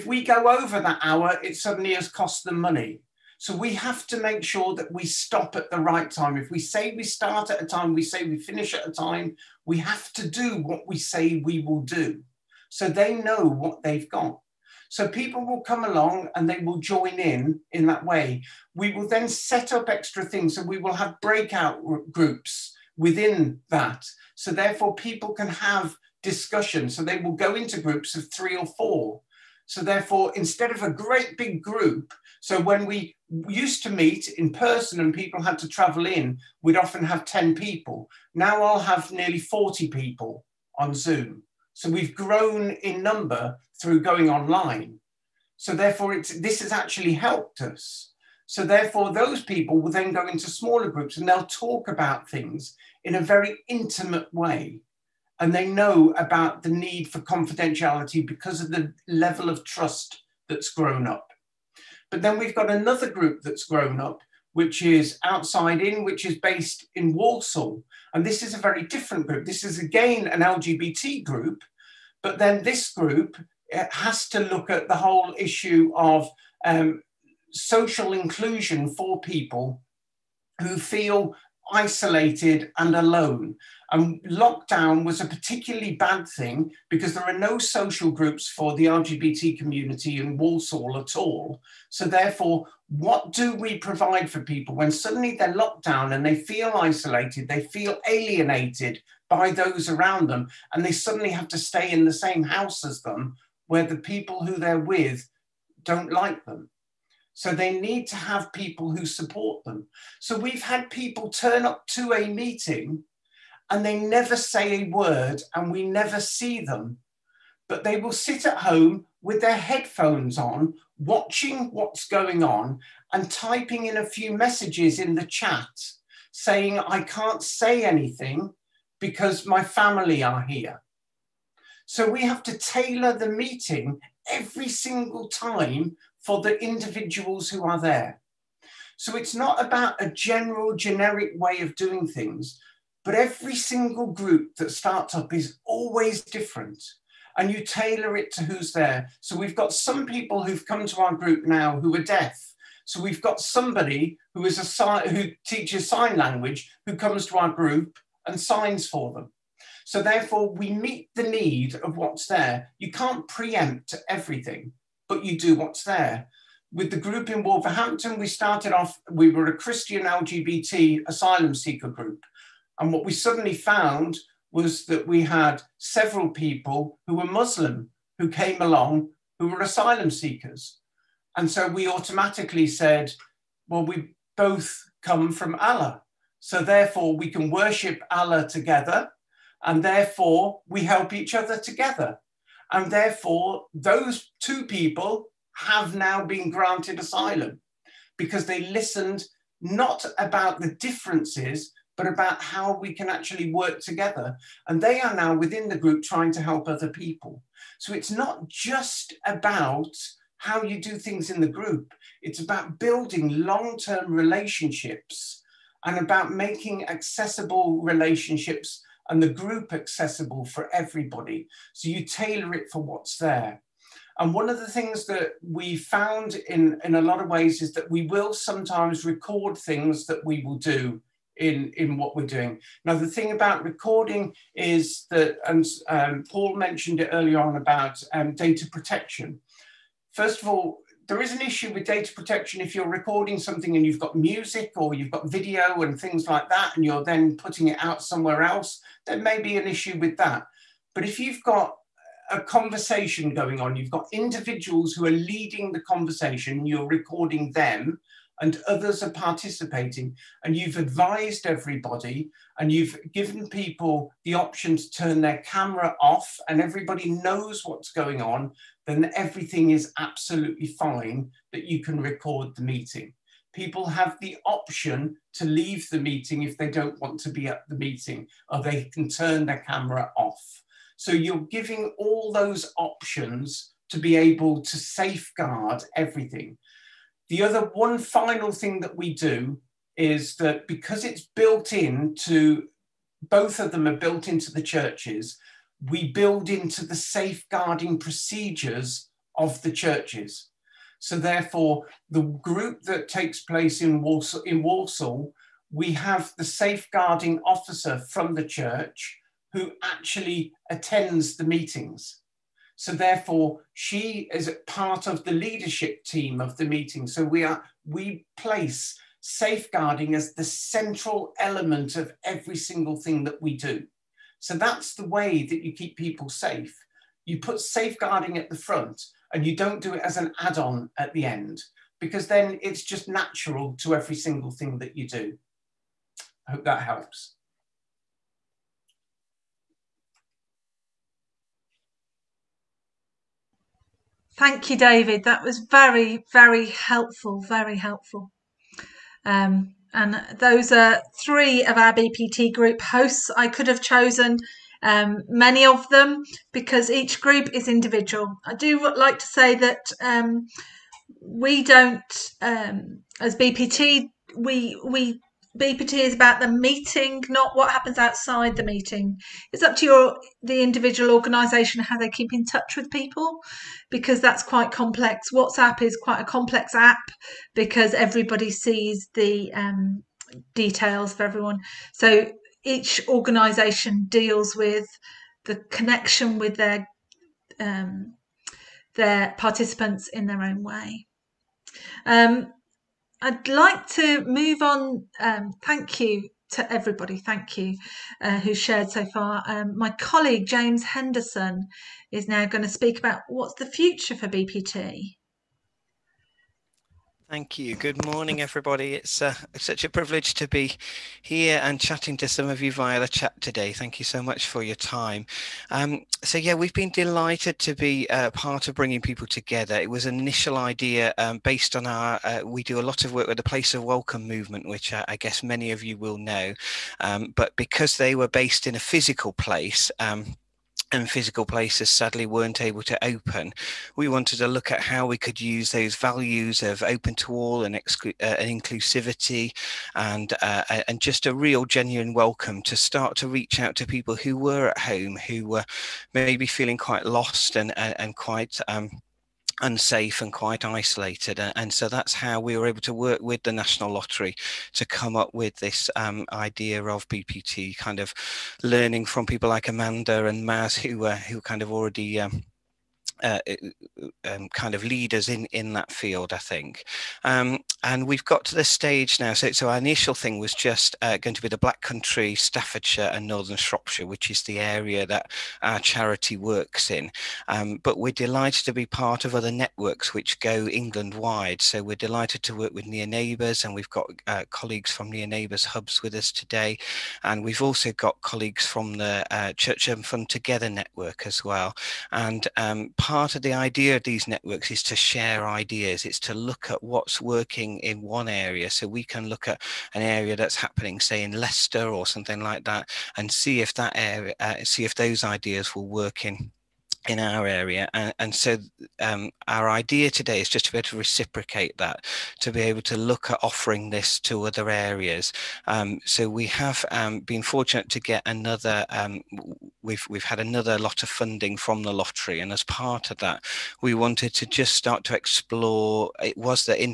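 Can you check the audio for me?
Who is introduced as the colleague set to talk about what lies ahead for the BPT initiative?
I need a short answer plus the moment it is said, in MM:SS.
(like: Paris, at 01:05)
James Henderson, at 06:40.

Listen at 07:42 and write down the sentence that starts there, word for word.
Um, uh, um, kind of leaders in in that field, I think.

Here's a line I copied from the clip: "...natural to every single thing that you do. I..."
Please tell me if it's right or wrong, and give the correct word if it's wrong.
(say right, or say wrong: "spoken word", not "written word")
right.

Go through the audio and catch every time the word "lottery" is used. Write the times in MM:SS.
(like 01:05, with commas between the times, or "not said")
07:33, 08:41.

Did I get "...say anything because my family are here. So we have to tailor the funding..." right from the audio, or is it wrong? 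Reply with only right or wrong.
wrong.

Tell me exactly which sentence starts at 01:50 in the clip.
So we've had people turn up to a meeting and they never say a word and we never see them.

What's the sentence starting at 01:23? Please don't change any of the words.
And lockdown was a particularly bad thing because there are no social groups for the LGBT community in Walsall at all.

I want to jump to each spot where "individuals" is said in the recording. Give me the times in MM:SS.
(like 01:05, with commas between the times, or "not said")
02:16, 04:14, 05:57, 06:10.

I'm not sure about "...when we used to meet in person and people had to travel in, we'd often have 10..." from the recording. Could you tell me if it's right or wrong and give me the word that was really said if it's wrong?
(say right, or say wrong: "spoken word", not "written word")
right.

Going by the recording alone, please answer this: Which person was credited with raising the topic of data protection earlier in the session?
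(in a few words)
Paul.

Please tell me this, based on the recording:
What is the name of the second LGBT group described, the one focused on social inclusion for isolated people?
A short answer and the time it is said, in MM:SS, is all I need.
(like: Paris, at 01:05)
Outside In, at 01:05.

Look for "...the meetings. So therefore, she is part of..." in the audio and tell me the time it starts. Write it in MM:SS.
05:11.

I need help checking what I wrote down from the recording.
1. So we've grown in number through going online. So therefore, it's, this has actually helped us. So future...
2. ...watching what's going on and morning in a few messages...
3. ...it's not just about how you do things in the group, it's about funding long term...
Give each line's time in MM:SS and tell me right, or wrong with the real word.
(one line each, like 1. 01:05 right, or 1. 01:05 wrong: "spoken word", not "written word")
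1. 00:41 wrong: "therefore", not "future"
2. 02:00 wrong: "typing", not "morning"
3. 03:27 wrong: "building", not "funding".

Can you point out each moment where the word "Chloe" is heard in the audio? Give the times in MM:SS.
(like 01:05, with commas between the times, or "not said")
not said.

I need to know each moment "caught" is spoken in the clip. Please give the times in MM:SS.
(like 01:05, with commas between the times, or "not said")
not said.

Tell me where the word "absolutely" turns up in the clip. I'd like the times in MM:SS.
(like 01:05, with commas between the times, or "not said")
04:29.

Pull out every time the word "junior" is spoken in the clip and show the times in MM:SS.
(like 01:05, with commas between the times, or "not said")
not said.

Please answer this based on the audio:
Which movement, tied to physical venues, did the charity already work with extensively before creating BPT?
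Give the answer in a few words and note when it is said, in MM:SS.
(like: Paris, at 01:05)
Place of Welcome, at 07:03.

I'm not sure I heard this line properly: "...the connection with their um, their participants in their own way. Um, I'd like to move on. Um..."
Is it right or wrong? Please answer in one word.
right.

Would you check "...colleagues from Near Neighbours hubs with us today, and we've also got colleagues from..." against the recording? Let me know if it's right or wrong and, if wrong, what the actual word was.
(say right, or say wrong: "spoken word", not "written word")
right.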